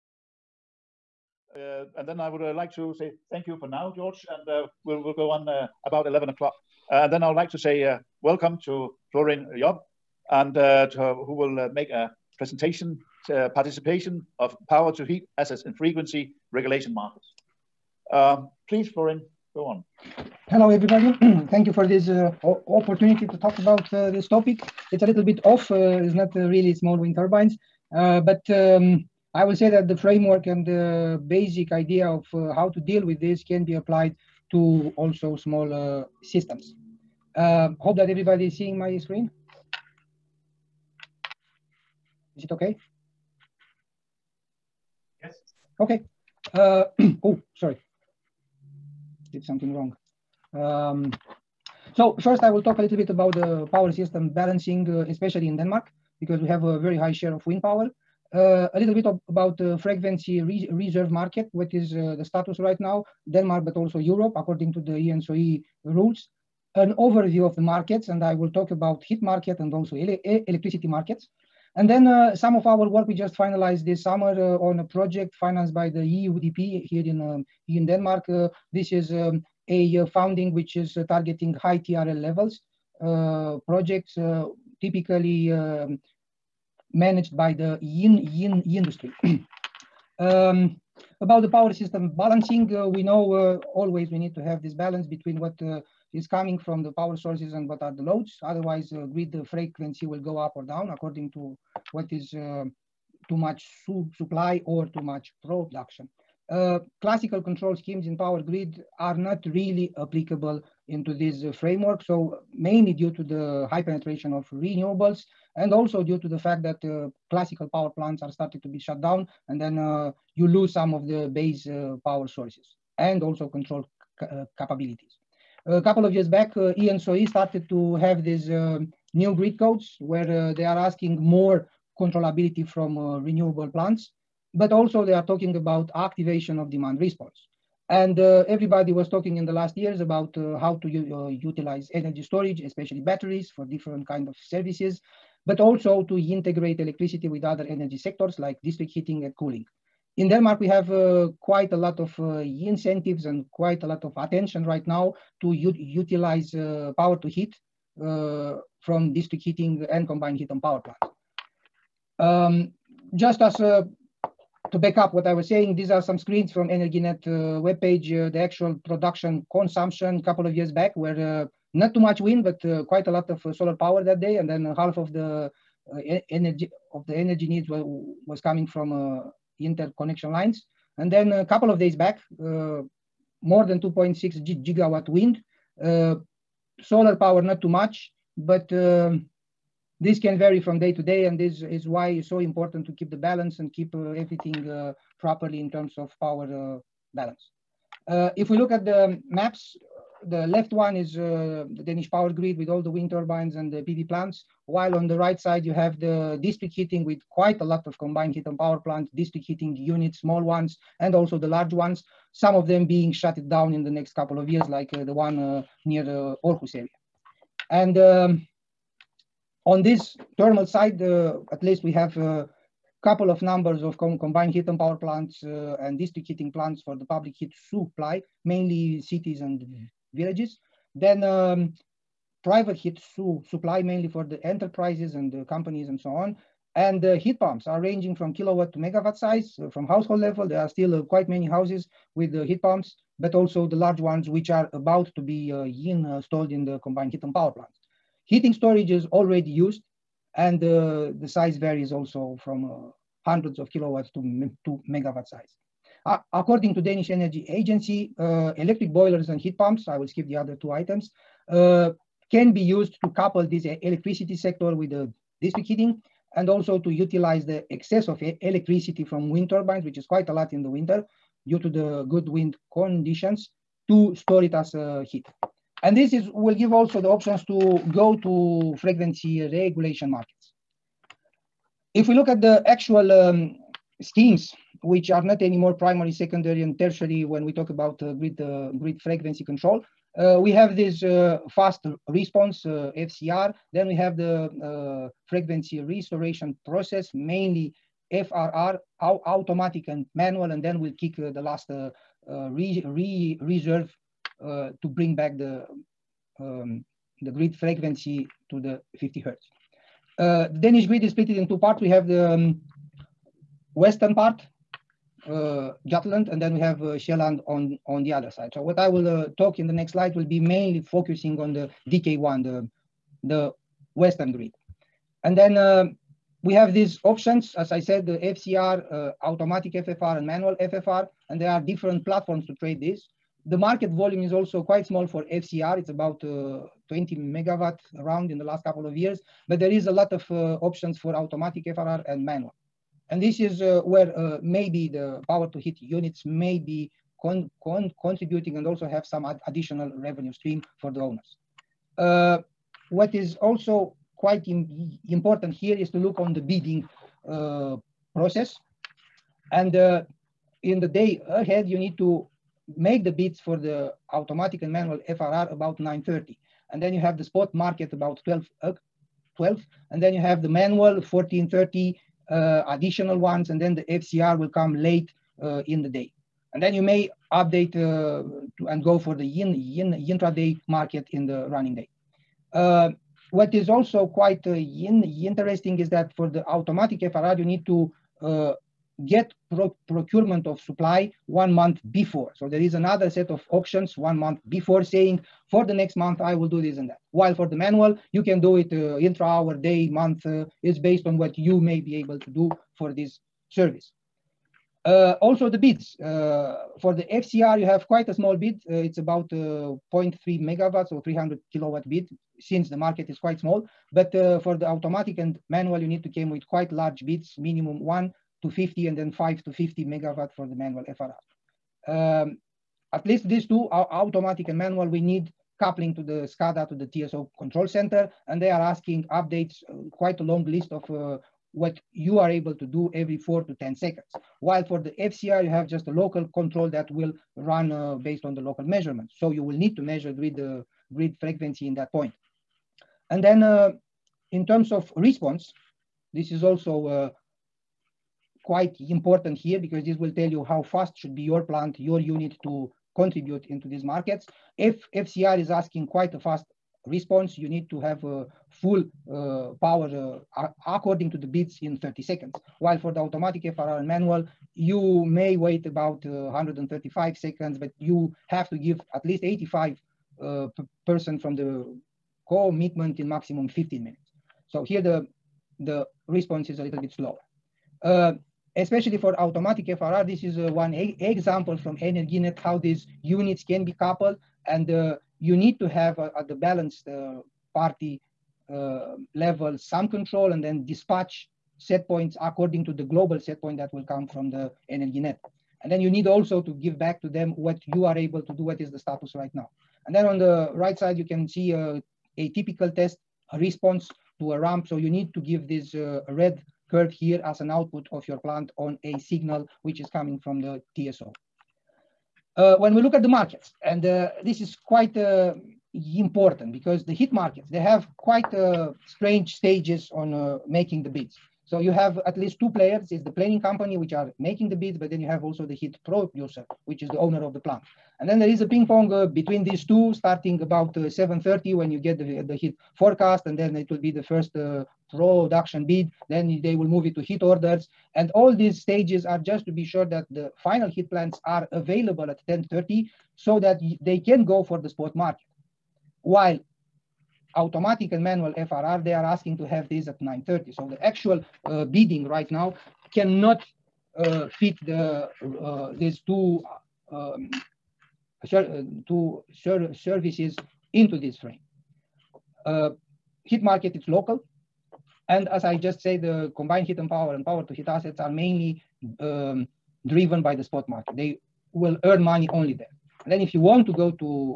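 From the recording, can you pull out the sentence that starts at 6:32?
So there is another set of auctions one month before saying for the next month I will do this and that.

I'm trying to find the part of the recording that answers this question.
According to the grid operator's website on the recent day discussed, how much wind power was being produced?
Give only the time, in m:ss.
3:03.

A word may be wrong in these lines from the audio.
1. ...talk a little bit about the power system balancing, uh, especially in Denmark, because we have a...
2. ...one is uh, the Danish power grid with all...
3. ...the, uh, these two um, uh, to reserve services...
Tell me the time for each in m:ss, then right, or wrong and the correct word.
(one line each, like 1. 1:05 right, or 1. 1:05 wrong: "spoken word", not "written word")
1. 0:52 right
2. 3:20 right
3. 9:14 wrong: "serve", not "reserve".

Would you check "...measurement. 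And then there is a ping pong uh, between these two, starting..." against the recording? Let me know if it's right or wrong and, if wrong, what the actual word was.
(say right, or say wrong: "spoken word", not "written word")
wrong: "plant", not "measurement".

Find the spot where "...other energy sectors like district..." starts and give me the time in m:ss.
2:27.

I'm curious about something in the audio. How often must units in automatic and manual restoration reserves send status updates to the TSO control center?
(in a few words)
every 4 to 10 seconds.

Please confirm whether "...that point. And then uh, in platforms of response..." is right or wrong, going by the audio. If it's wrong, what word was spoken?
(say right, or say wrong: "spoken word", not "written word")
wrong: "terms", not "platforms".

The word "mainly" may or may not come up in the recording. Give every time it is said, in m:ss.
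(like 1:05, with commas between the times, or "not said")
1:52, 3:48, 3:53, 4:57, 5:20, 9:28.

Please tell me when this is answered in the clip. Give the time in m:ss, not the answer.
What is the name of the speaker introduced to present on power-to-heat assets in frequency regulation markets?
0:09.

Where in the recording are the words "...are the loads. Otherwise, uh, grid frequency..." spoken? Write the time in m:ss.
1:37.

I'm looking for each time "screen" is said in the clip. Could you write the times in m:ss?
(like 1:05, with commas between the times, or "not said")
0:38, 2:46.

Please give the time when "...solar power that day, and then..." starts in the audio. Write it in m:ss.
2:53.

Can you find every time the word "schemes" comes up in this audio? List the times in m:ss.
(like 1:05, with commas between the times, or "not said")
1:47, 4:44.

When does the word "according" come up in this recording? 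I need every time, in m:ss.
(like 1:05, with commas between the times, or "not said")
1:04, 1:40, 4:16, 7:40, 8:12.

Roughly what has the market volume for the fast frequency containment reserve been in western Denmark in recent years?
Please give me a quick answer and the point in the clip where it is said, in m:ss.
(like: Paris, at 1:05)
20 megawatt, at 5:36.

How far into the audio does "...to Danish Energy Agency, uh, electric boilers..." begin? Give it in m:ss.
4:16.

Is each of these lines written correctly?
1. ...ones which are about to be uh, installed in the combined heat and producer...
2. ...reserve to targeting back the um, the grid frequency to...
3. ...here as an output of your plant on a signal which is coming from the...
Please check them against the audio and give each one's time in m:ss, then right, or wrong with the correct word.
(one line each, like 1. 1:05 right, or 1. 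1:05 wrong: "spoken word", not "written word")
1. 4:03 wrong: "power", not "producer"
2. 5:03 wrong: "bring", not "targeting"
3. 8:26 right.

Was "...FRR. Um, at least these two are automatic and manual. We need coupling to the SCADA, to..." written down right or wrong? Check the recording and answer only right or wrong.
right.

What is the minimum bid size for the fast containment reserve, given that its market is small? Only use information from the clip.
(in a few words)
300 kilowatt.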